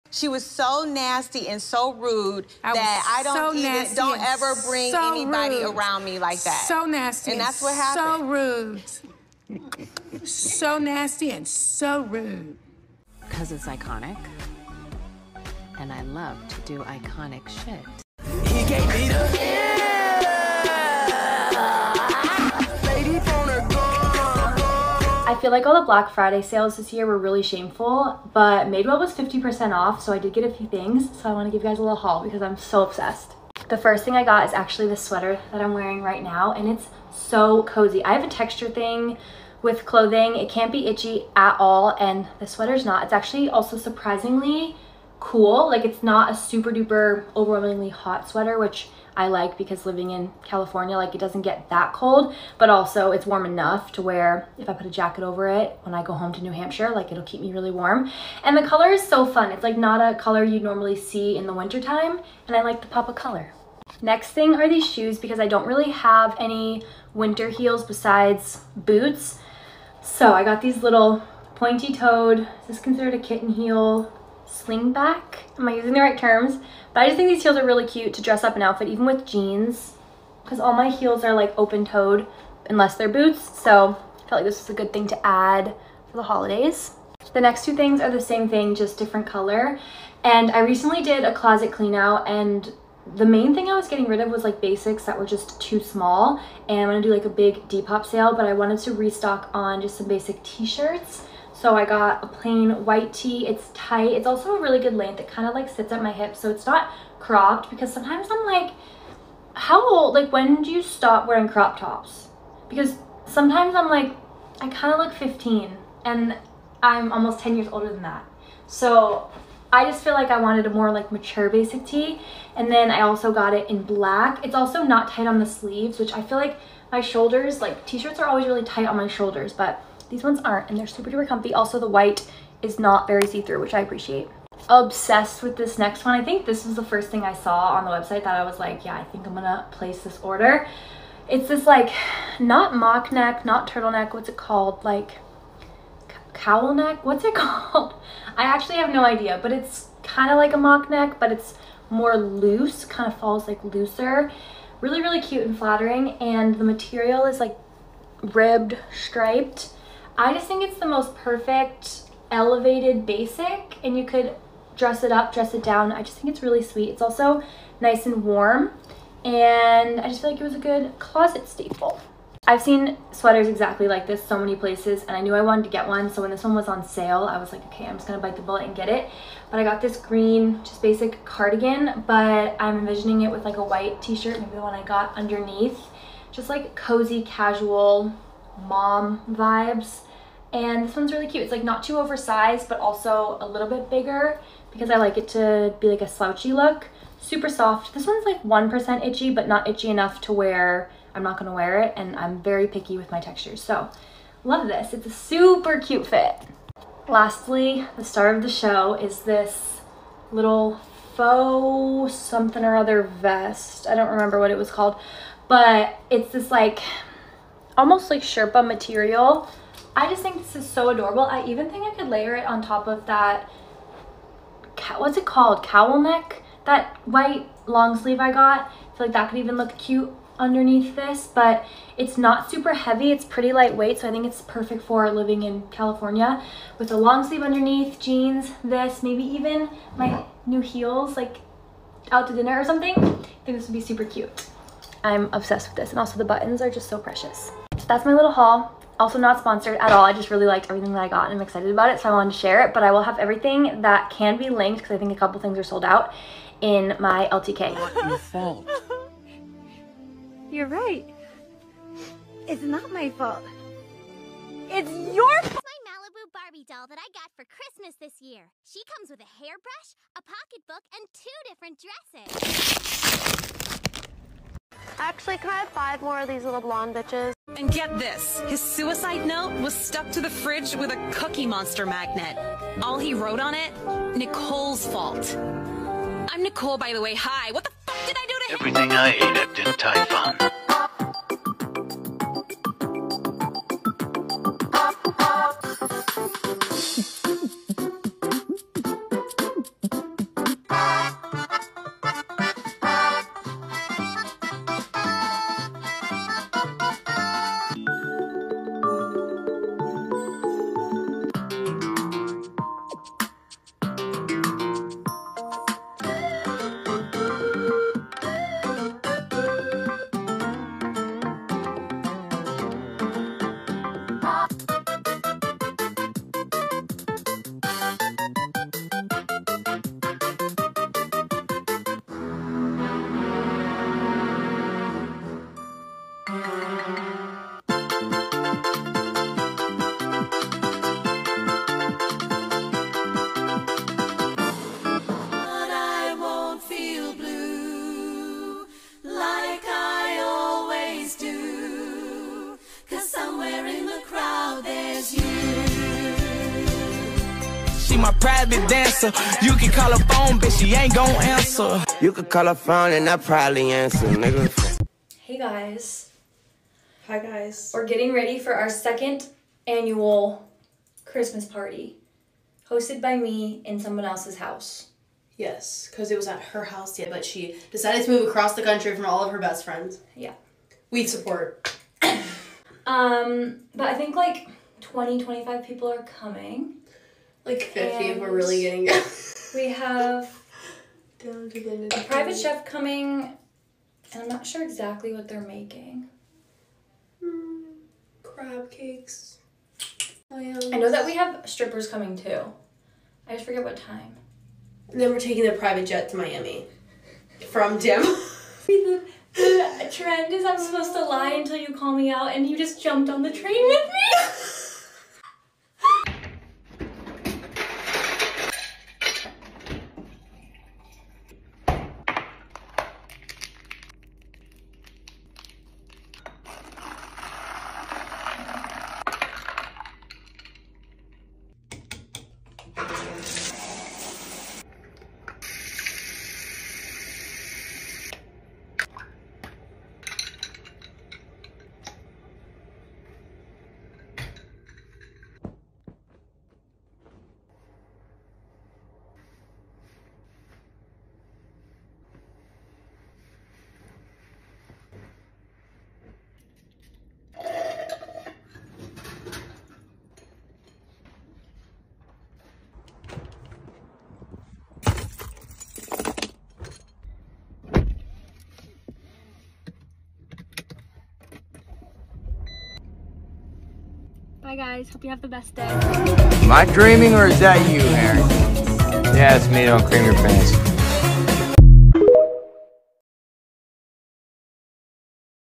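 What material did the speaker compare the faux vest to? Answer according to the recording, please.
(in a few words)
Sherpa.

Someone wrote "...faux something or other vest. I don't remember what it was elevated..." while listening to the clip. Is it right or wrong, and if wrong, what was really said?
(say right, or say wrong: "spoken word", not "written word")
wrong: "called", not "elevated".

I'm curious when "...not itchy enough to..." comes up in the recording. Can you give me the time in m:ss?
3:19.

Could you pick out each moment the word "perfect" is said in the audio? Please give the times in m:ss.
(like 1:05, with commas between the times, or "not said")
2:41, 3:54.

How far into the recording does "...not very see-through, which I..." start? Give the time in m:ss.
2:12.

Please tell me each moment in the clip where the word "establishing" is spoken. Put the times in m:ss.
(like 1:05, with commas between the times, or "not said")
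not said.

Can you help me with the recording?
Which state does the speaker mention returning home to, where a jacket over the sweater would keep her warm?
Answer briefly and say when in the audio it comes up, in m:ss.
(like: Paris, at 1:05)
New Hampshire, at 0:56.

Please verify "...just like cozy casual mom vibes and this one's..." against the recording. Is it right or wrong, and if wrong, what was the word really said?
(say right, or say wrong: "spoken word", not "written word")
right.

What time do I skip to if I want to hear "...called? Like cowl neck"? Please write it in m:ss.
2:24.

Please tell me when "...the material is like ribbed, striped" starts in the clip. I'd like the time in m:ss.
2:36.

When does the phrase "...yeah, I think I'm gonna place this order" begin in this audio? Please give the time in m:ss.
2:18.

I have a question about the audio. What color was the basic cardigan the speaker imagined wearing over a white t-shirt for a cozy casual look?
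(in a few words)
Green.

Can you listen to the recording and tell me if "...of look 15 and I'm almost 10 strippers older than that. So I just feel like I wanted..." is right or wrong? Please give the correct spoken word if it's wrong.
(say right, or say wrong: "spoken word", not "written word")
wrong: "years", not "strippers".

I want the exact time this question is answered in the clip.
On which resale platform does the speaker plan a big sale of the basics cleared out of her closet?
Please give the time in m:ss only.
1:37.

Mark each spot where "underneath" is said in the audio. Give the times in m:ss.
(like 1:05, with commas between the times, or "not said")
3:05, 3:50, 3:57.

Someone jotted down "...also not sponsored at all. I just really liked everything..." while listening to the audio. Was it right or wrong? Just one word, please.
right.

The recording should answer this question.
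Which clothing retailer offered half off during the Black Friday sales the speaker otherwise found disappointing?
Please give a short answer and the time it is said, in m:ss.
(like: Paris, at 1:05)
Madewell, at 0:28.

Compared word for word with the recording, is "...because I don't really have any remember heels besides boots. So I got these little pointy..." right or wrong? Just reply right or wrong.
wrong.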